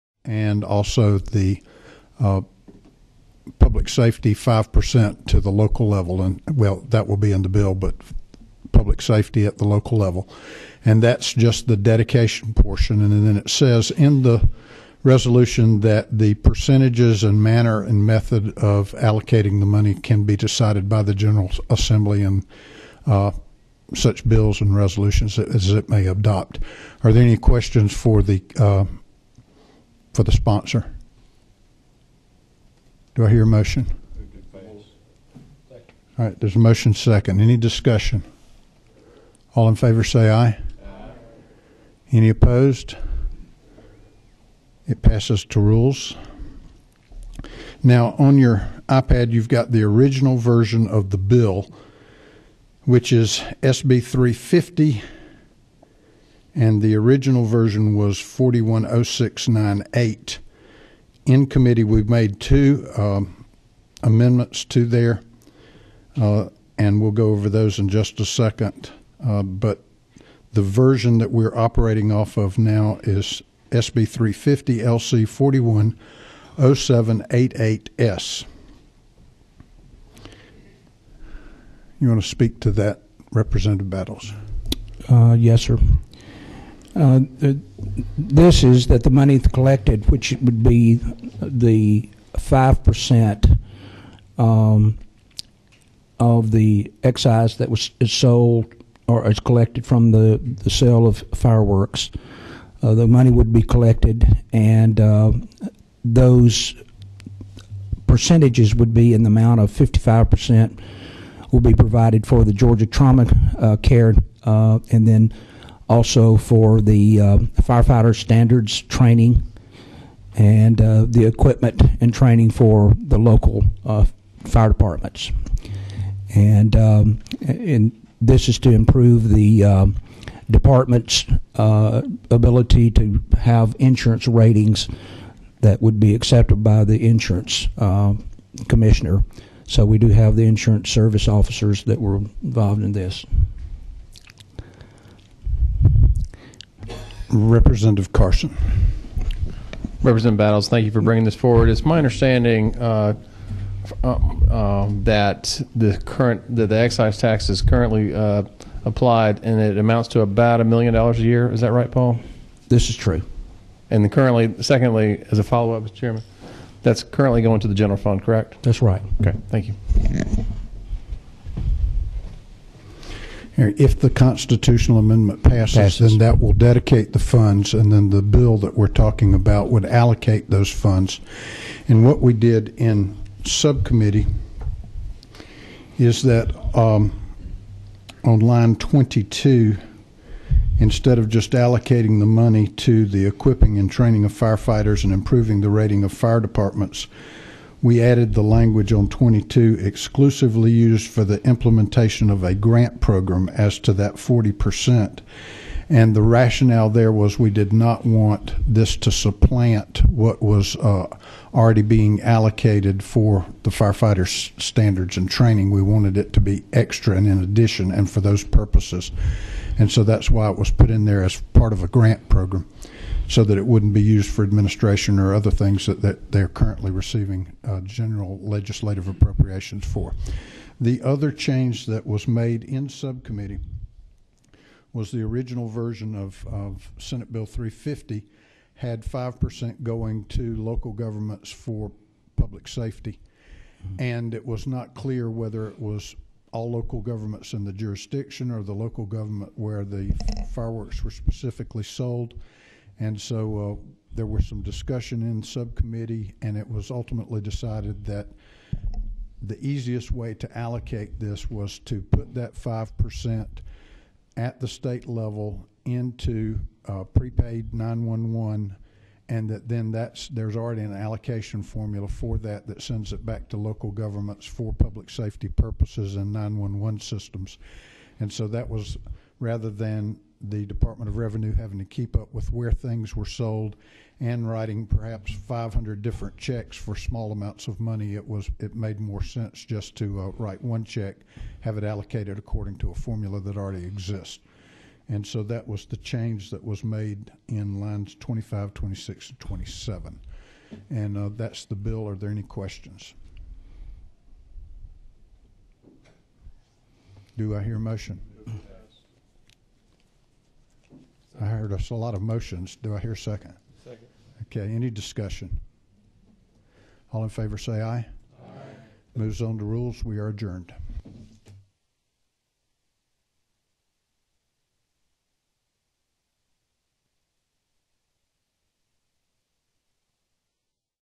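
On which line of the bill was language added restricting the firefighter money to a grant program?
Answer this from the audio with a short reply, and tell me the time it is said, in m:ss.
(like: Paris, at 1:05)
22, at 3:08.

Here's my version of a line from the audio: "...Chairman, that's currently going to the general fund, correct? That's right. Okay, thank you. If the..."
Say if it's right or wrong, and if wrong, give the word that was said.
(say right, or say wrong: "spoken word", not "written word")
right.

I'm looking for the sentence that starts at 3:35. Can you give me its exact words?
We wanted it to be extra and in addition and for those purposes.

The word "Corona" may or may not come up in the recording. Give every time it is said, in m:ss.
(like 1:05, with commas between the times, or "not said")
not said.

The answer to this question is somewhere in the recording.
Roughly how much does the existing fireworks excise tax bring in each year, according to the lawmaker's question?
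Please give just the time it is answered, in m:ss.
2:40.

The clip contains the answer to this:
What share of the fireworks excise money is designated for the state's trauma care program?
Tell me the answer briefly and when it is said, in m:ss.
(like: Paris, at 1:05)
55%, at 1:49.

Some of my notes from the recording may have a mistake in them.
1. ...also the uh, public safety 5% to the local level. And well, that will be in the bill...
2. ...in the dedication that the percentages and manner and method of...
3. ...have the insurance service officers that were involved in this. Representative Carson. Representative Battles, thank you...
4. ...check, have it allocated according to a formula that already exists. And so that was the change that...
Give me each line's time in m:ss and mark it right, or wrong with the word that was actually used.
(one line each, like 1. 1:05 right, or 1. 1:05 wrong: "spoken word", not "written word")
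1. 0:00 right
2. 0:13 wrong: "resolution", not "dedication"
3. 2:20 right
4. 4:50 right.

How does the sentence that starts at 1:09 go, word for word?
Uh, but the version that we're operating off of now is SB 350 LC 410788S.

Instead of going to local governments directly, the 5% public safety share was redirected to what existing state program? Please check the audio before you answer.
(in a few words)
Prepaid 911.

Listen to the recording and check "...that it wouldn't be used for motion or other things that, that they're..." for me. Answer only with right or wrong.
wrong.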